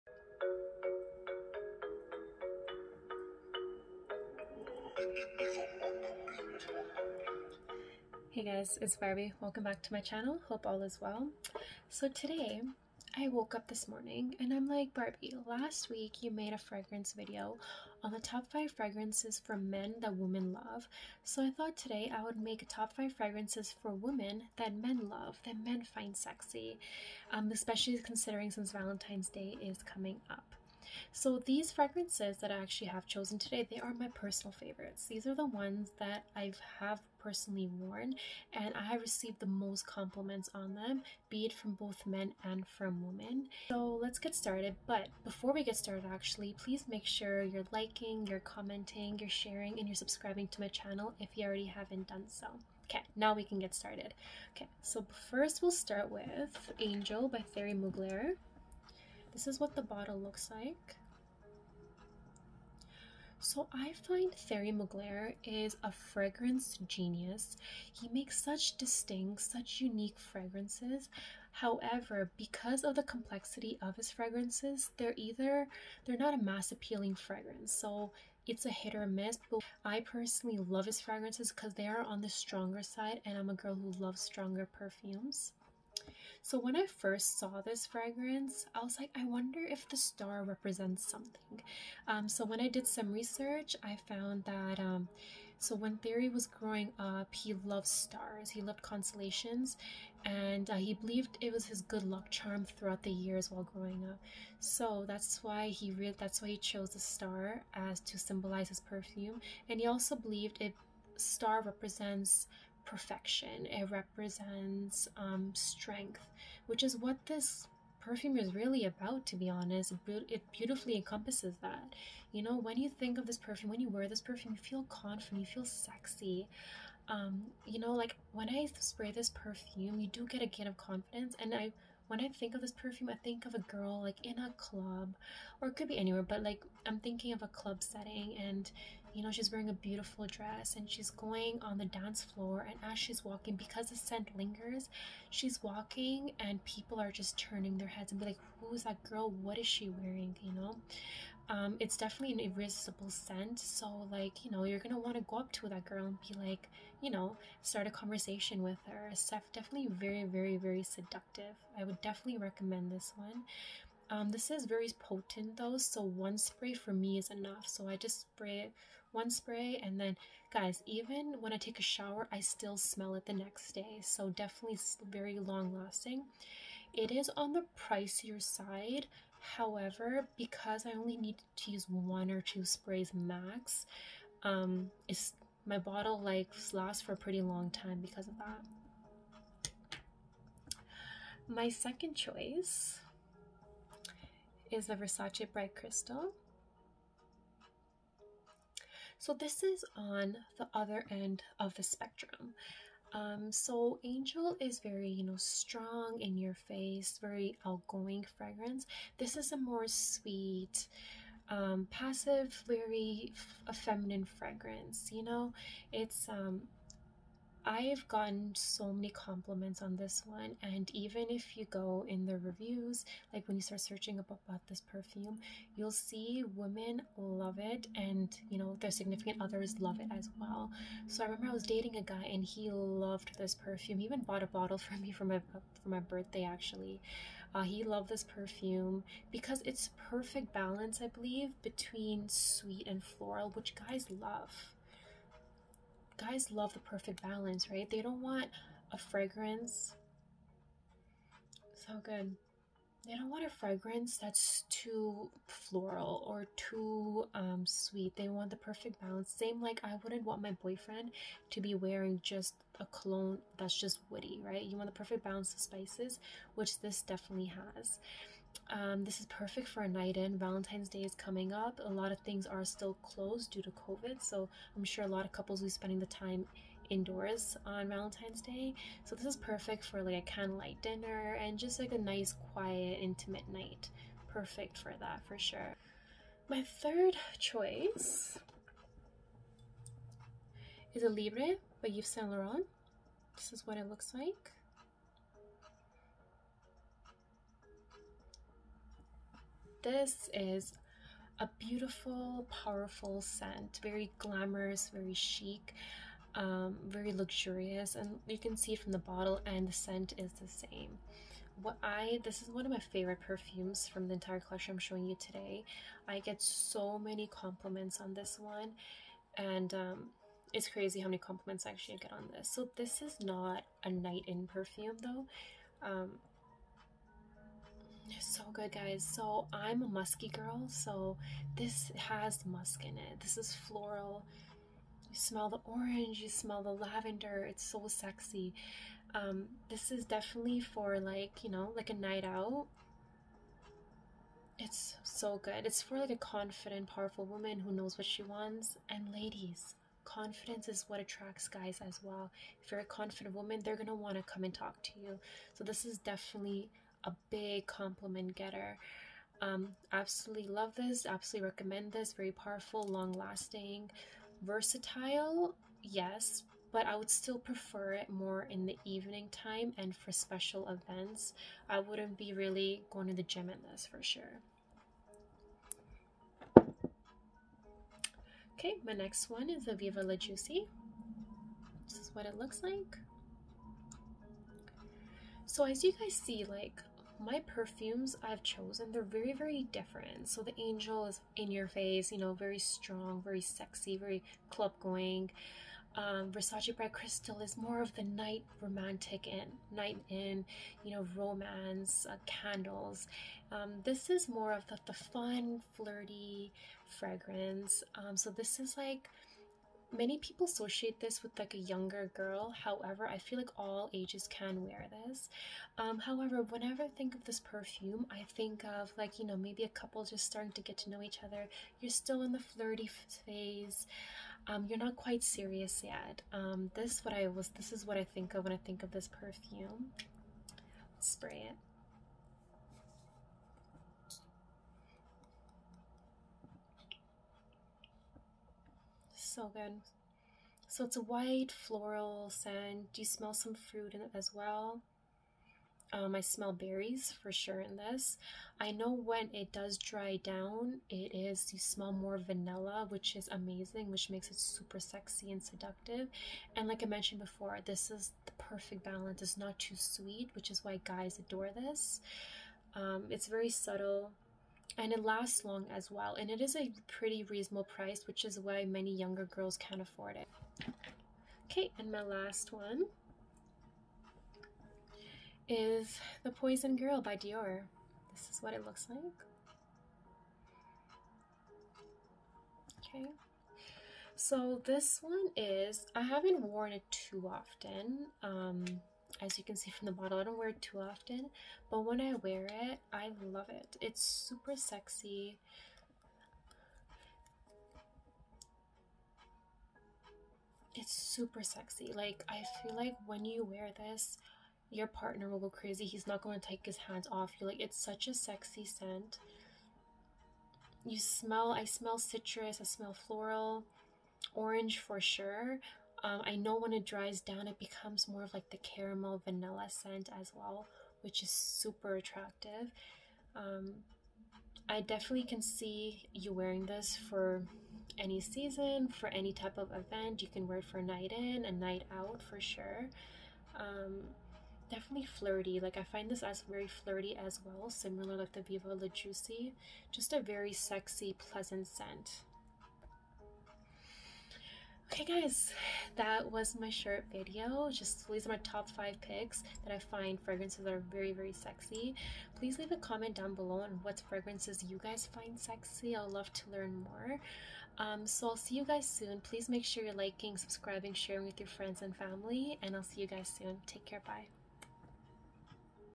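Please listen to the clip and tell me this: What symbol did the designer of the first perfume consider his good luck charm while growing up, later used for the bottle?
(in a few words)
Stars.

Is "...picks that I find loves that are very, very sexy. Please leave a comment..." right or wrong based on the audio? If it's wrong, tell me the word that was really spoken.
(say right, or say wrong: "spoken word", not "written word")
wrong: "fragrances", not "loves".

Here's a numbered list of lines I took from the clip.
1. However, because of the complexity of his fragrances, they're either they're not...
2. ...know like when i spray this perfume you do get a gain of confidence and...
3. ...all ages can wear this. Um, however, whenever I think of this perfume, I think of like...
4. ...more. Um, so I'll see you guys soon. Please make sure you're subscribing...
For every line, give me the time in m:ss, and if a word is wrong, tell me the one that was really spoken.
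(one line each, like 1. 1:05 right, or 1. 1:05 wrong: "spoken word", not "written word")
1. 1:11 right
2. 2:07 right
3. 6:53 right
4. 9:16 wrong: "liking", not "subscribing".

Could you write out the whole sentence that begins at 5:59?
Um, absolutely love this, absolutely recommend this.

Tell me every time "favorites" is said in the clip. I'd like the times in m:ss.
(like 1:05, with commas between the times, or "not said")
0:34, 5:12.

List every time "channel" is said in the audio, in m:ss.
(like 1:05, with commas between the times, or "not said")
0:09, 0:50.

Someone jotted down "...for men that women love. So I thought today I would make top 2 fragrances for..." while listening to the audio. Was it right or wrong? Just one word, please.
wrong.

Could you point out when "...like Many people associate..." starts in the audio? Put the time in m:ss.
6:48.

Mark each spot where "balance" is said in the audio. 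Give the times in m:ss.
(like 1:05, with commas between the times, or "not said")
4:00, 4:07, 4:19, 4:25, 7:38.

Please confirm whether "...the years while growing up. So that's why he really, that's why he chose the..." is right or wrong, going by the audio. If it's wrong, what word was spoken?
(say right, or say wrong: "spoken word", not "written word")
right.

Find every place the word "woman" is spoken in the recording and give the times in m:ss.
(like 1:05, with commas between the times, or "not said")
5:47, 5:53.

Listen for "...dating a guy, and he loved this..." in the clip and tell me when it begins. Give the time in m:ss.
3:51.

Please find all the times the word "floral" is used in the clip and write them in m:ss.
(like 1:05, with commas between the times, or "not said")
4:03, 4:15, 5:33, 7:21, 8:32.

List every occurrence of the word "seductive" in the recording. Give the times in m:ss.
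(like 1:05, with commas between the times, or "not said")
2:40, 7:35.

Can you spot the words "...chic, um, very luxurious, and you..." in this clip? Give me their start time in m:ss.
5:05.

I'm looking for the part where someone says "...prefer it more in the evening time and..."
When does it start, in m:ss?
6:07.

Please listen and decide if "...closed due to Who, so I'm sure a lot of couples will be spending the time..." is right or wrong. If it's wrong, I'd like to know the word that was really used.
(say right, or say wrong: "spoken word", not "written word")
wrong: "COVID", not "Who".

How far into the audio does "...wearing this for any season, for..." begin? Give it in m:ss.
8:46.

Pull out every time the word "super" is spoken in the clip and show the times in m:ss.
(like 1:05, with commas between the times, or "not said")
7:34, 8:14, 8:20, 8:41.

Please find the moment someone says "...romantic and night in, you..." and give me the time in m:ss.
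6:38.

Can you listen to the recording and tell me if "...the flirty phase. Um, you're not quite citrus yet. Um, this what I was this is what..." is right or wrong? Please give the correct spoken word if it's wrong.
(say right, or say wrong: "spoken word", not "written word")
wrong: "serious", not "citrus".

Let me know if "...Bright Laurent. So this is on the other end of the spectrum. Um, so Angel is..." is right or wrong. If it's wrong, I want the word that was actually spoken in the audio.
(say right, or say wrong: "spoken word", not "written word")
wrong: "Crystal", not "Laurent".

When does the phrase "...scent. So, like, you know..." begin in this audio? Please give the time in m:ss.
2:33.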